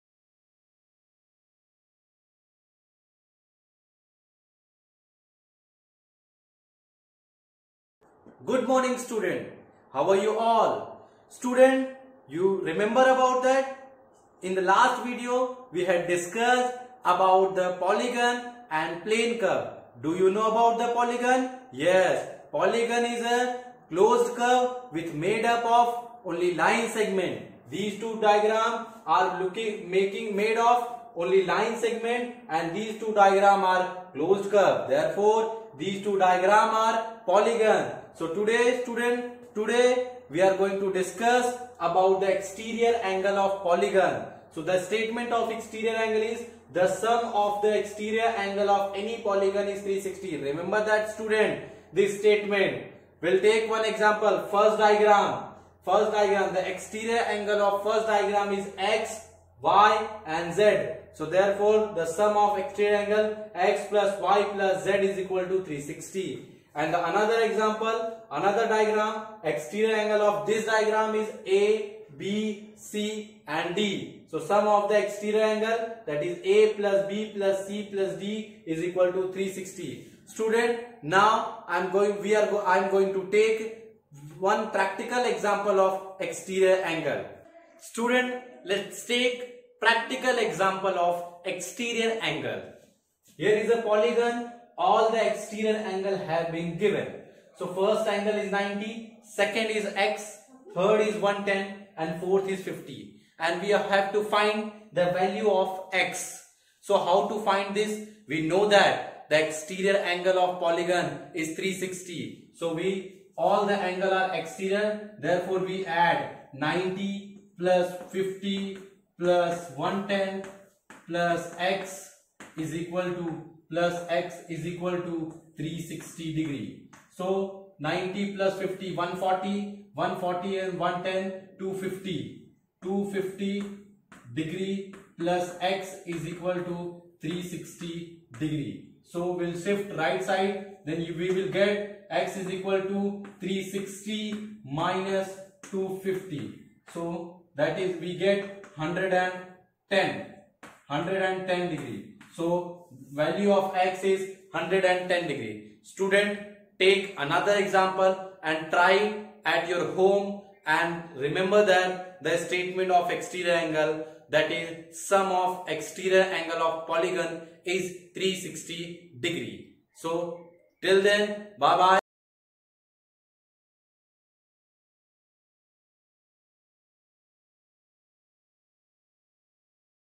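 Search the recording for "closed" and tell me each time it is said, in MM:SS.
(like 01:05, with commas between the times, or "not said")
00:23, 00:34.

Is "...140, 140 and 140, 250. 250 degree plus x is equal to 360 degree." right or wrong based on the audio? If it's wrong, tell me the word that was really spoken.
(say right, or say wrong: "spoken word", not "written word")
wrong: "110", not "140".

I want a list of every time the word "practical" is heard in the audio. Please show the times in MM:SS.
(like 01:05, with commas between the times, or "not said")
01:24, 01:29.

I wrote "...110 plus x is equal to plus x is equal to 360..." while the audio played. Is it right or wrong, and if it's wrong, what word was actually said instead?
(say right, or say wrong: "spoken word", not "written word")
right.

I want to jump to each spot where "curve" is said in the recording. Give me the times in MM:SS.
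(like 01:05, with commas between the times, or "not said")
00:19, 00:24, 00:34.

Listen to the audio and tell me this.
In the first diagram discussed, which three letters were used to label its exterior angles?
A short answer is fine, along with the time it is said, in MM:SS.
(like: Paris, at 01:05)
x, y and z, at 00:58.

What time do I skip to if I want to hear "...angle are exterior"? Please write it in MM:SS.
01:53.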